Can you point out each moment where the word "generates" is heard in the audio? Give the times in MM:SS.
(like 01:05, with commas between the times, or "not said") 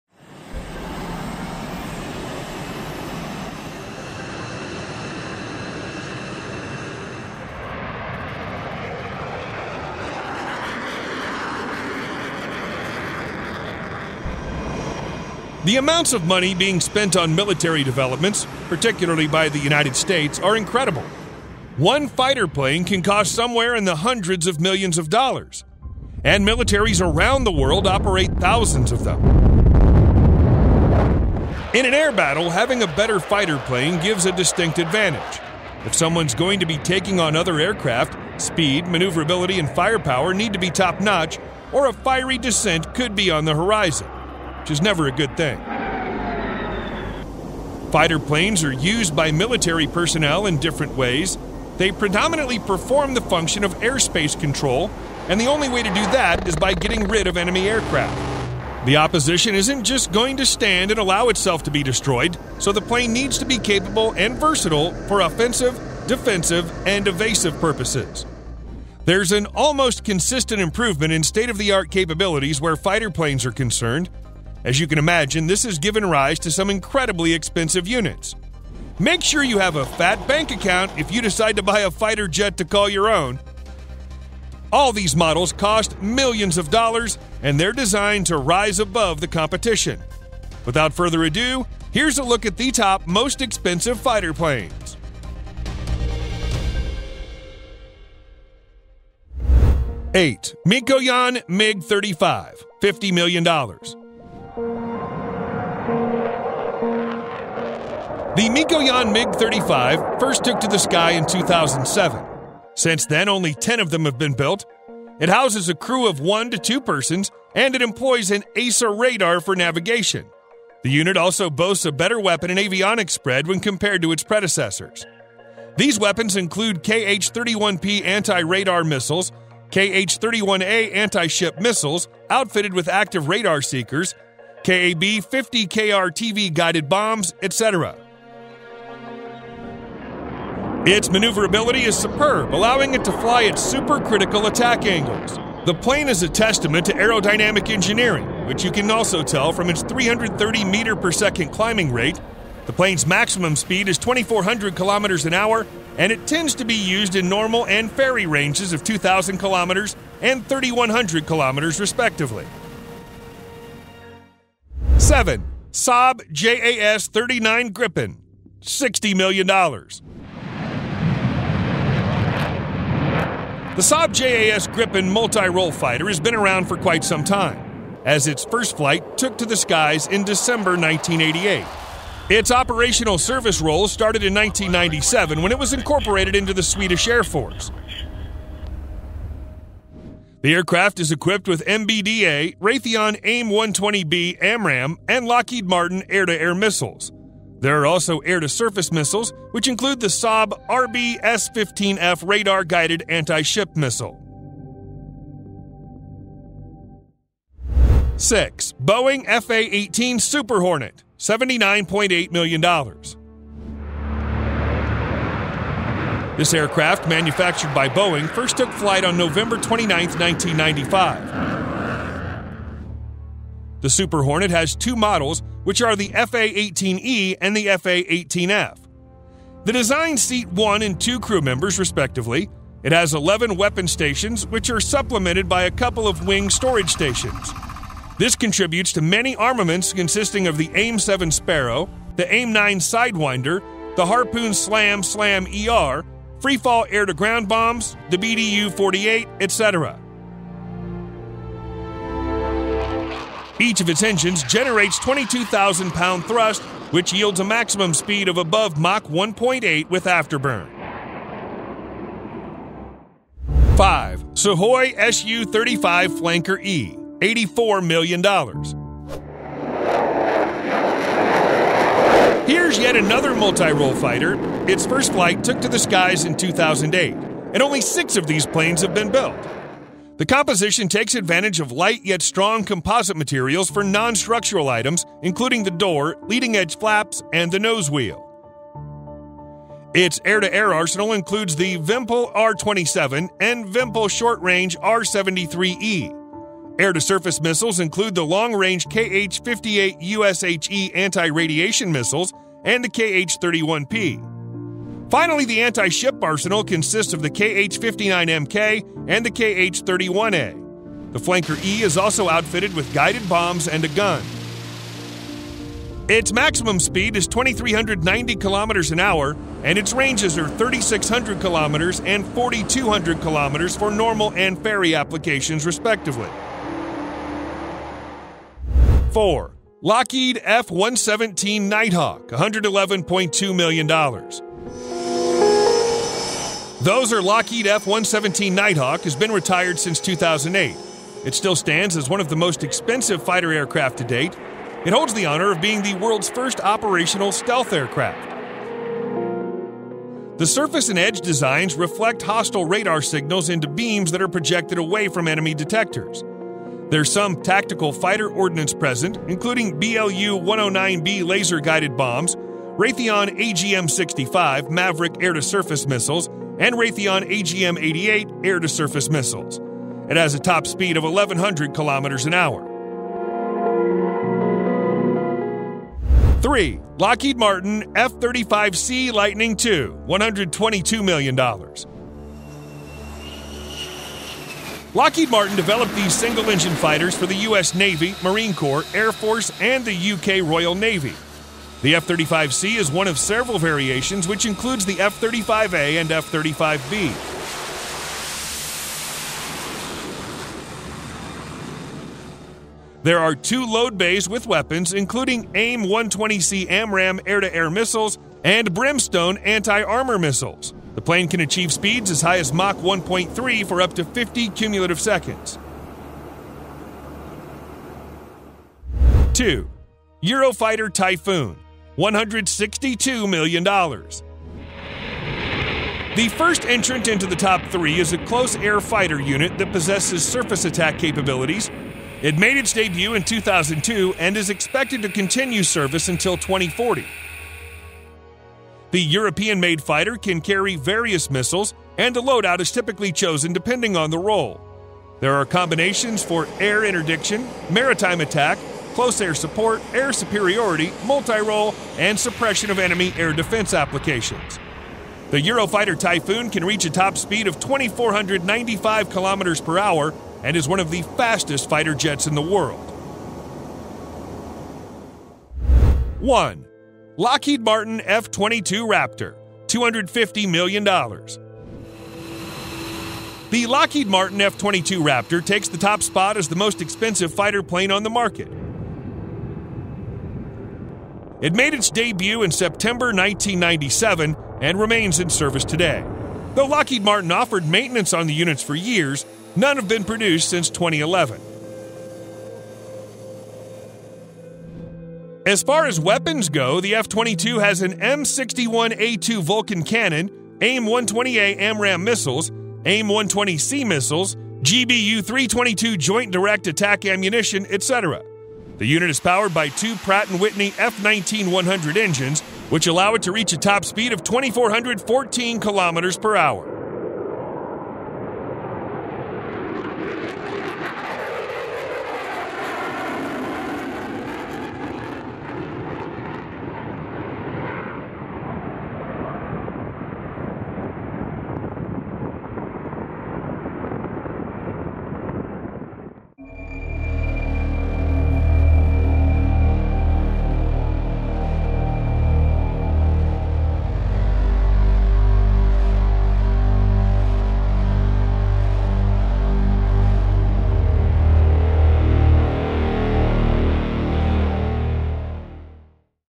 04:14.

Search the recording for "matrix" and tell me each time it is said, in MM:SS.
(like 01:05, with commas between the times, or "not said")
not said.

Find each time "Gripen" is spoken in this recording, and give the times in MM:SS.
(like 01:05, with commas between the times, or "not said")
02:47, 02:54.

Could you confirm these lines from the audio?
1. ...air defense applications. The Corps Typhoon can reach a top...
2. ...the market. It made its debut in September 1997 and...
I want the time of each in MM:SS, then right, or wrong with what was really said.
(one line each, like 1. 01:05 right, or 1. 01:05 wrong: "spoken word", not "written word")
1. 07:33 wrong: "Eurofighter", not "Corps"
2. 07:58 right.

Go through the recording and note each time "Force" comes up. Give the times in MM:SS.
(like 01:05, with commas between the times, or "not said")
03:07, 06:29.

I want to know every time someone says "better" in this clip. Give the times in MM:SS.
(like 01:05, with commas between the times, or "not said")
00:32, 02:01.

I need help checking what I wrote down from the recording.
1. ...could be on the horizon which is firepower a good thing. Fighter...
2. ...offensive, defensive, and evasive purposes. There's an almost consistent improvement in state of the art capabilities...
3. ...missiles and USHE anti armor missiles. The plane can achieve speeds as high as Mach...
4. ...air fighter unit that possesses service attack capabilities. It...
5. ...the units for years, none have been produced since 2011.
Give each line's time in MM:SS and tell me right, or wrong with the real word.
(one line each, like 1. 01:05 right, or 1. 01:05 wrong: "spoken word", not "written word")
1. 00:42 wrong: "never", not "firepower"
2. 01:05 right
3. 06:47 wrong: "Brimstone", not "USHE"
4. 07:08 wrong: "surface", not "service"
5. 08:08 right.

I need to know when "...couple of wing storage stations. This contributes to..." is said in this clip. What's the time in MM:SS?
03:55.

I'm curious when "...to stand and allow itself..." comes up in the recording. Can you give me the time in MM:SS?
01:00.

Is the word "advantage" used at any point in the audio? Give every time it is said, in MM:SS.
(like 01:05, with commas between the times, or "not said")
00:34, 04:41.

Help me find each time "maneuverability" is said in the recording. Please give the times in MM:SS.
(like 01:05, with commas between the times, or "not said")
00:38, 02:21.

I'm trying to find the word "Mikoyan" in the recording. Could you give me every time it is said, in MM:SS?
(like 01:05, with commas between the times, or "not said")
01:40, 01:48.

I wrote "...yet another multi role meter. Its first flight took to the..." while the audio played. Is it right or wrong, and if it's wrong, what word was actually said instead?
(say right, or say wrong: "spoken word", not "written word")
wrong: "fighter", not "meter".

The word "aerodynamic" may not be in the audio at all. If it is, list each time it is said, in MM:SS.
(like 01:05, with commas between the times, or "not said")
02:26.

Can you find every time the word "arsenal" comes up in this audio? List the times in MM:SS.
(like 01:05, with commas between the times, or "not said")
04:50, 05:06.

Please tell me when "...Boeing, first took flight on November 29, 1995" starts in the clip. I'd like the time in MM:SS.
03:37.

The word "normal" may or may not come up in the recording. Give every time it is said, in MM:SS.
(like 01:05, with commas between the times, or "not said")
02:37, 05:23.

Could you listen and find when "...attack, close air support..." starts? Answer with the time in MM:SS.
07:28.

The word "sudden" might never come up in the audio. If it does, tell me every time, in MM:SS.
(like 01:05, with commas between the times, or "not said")
not said.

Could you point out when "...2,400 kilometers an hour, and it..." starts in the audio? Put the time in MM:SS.
02:33.